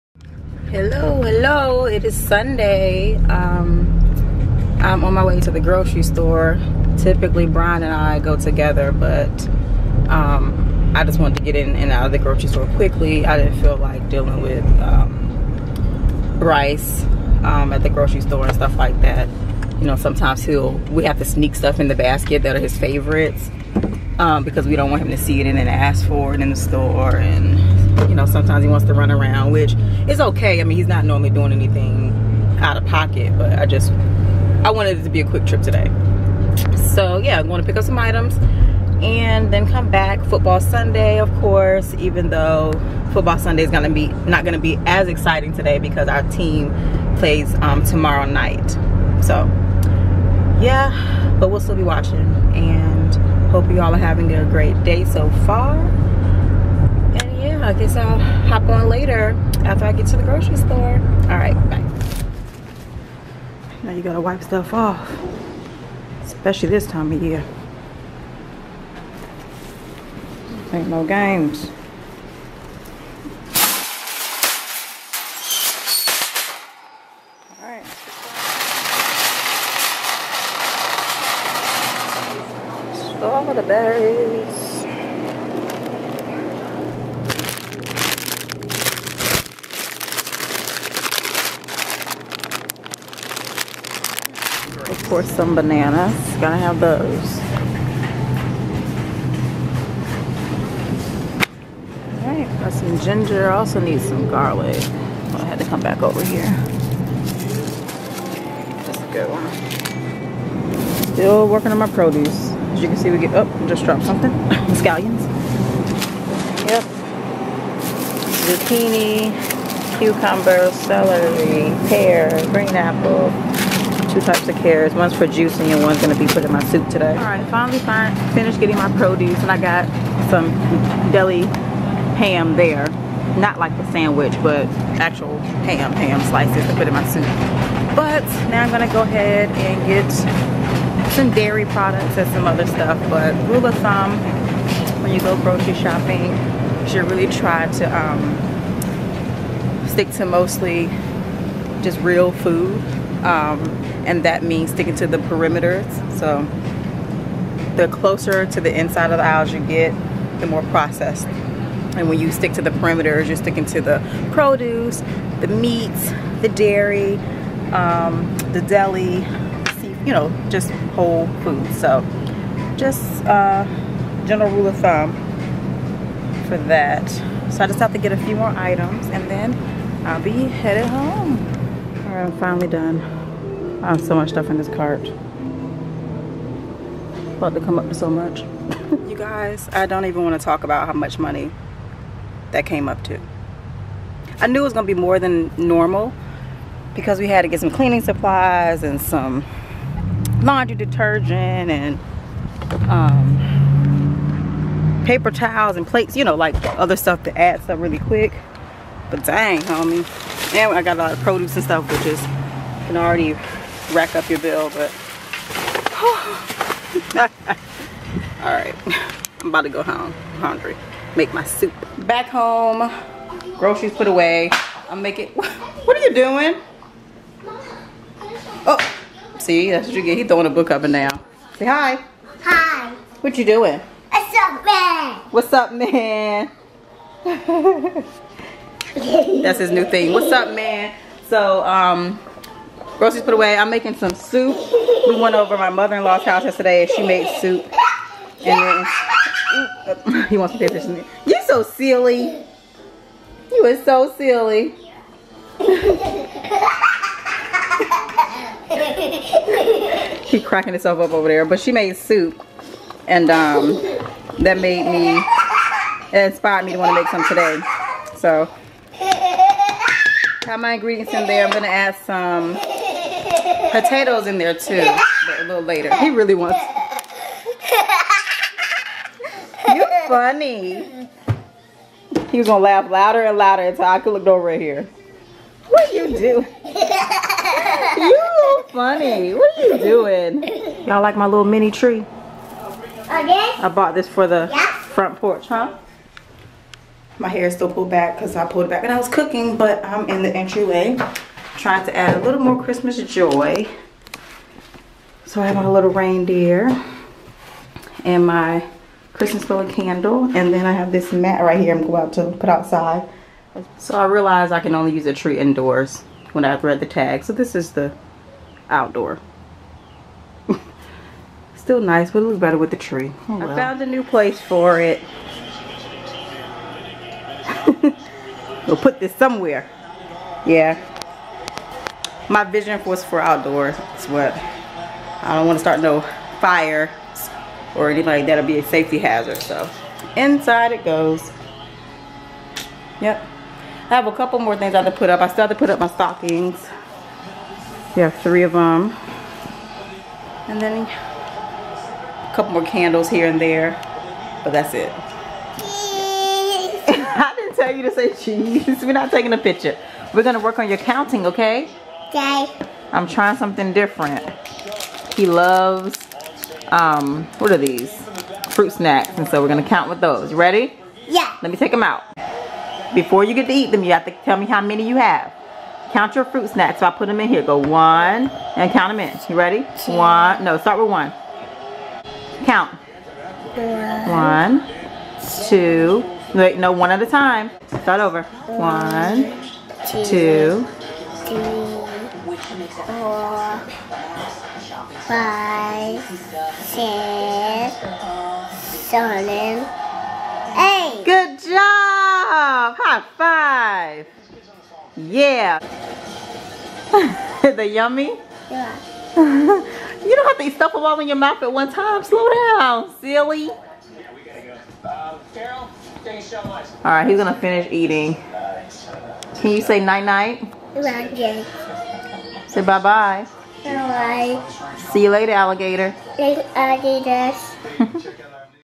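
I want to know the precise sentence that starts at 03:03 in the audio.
I have so much stuff in this cart.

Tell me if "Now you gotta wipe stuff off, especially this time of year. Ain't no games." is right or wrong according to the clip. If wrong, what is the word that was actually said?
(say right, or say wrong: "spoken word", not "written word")
right.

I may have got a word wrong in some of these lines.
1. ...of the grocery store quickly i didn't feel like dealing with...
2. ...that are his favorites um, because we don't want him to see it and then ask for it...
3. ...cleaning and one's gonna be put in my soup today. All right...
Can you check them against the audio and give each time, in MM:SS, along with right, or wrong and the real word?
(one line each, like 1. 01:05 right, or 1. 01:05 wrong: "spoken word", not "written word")
1. 00:12 right
2. 00:22 right
3. 02:05 wrong: "juicing", not "cleaning".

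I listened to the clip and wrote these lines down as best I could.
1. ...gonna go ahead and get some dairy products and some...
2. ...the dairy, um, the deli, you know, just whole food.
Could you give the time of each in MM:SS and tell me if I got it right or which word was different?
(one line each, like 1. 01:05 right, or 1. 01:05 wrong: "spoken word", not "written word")
1. 02:18 right
2. 02:46 right.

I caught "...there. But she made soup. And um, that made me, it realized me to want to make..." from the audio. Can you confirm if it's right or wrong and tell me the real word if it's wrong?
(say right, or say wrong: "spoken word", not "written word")
wrong: "inspired", not "realized".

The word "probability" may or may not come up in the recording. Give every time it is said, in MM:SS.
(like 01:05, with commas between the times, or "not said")
not said.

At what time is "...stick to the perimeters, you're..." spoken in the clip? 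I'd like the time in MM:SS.
02:42.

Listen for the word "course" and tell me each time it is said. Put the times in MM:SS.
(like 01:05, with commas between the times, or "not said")
00:41, 01:35.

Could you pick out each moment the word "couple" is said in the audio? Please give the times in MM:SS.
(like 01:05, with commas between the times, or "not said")
05:44, 05:52.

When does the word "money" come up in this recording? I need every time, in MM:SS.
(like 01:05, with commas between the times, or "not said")
03:11.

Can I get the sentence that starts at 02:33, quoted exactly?
Um, and that means sticking to the perimeters.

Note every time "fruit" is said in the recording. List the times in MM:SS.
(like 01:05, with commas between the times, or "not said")
06:08, 06:16.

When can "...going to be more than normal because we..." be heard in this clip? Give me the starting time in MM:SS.
03:14.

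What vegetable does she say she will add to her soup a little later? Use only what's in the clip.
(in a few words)
potatoes.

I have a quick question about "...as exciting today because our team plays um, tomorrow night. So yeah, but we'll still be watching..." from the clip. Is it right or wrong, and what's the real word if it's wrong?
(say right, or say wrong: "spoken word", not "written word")
right.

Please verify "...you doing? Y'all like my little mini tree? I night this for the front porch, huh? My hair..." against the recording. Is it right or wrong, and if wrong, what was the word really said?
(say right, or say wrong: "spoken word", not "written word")
wrong: "bought", not "night".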